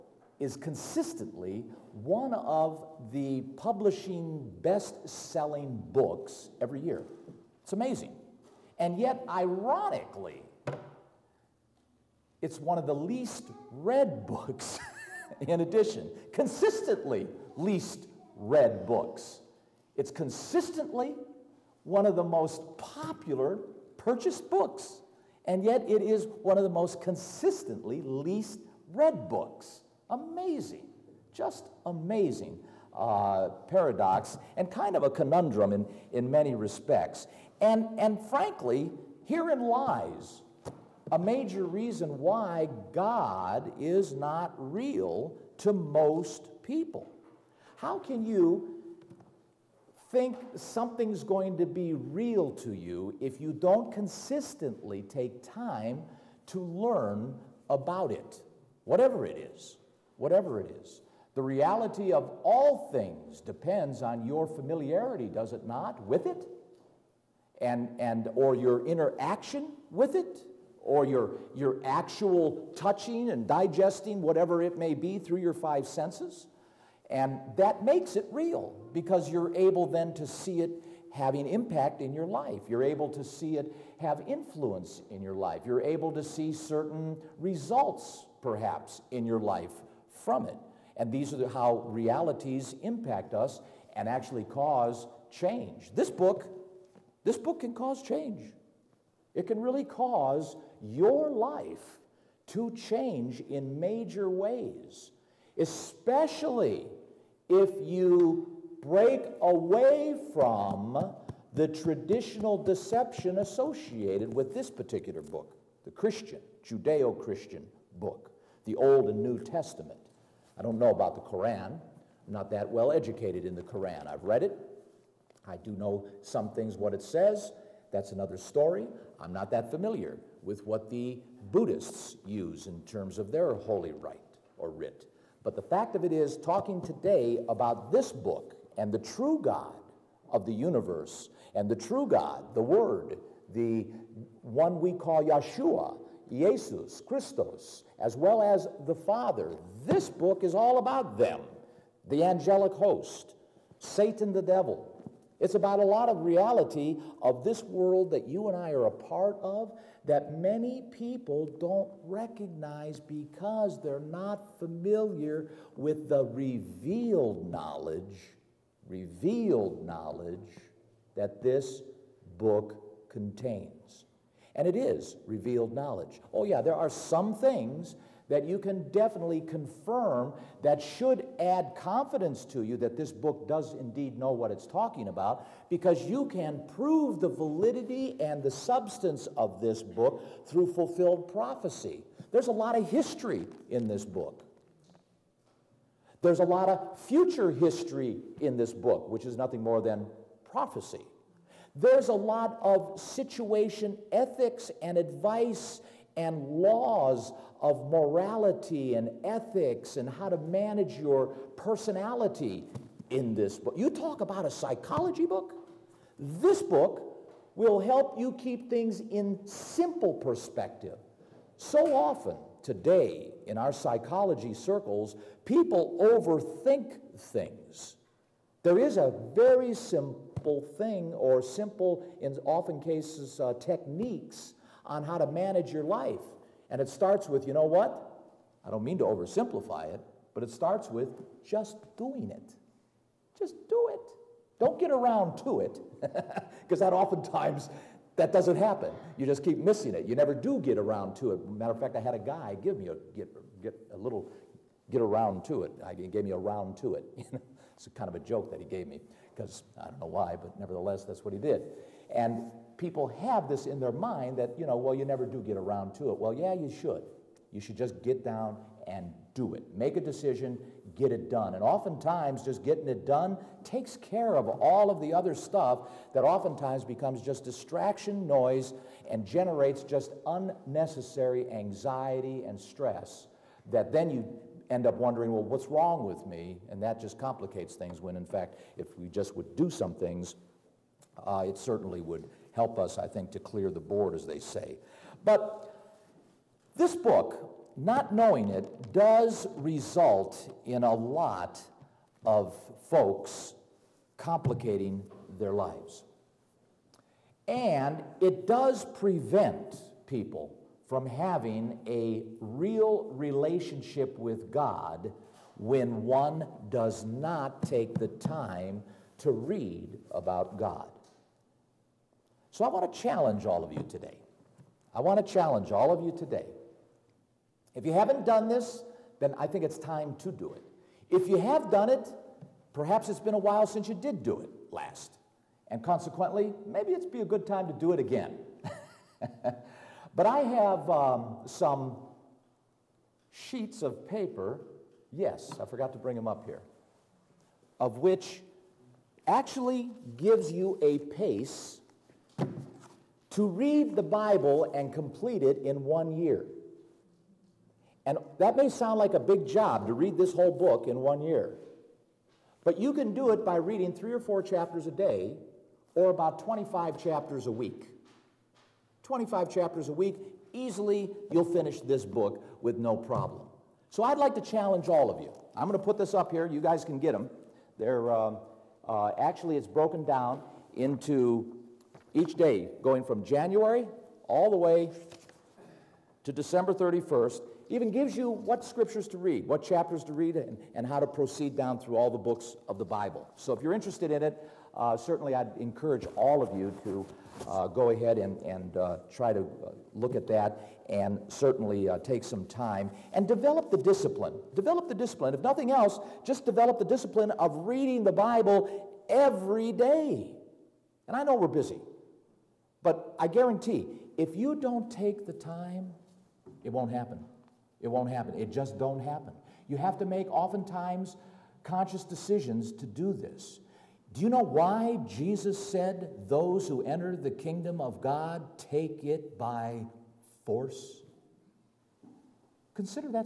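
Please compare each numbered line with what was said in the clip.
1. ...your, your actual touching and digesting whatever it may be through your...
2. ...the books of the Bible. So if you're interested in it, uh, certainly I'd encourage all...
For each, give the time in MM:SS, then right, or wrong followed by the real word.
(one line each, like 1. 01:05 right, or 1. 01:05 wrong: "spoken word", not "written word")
1. 01:11 right
2. 06:32 right.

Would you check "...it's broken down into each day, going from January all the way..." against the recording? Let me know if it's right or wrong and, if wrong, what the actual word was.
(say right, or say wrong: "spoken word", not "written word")
right.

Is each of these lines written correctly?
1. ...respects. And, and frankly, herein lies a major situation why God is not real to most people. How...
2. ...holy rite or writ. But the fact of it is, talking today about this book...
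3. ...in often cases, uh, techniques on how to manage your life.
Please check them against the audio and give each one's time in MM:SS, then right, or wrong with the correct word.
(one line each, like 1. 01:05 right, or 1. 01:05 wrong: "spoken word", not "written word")
1. 00:36 wrong: "reason", not "situation"
2. 02:13 right
3. 03:52 right.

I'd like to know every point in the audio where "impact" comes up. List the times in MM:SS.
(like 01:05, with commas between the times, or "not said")
01:21, 01:32.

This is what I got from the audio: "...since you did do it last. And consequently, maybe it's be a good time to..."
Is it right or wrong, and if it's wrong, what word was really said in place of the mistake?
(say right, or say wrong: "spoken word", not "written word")
right.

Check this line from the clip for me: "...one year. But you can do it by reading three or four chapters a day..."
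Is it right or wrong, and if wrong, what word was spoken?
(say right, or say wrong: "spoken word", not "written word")
right.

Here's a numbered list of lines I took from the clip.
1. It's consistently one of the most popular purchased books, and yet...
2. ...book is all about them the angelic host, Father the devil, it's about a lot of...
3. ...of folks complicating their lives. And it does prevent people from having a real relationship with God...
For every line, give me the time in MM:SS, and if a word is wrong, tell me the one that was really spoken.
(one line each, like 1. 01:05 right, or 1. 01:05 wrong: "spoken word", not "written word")
1. 00:19 right
2. 02:30 wrong: "Satan", not "Father"
3. 05:02 right.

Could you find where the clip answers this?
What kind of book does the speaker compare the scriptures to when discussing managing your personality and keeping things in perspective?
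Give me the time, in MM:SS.
03:34.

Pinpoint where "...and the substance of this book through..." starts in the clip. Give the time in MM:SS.
03:08.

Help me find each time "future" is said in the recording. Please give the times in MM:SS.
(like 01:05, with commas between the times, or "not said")
03:16.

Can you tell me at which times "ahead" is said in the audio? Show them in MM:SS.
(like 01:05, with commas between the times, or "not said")
06:37.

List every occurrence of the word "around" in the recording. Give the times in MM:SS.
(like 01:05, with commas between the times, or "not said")
04:04, 04:10, 04:15, 04:25.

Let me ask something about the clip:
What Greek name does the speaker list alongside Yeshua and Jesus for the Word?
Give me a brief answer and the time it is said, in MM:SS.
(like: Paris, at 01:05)
Christos, at 02:27.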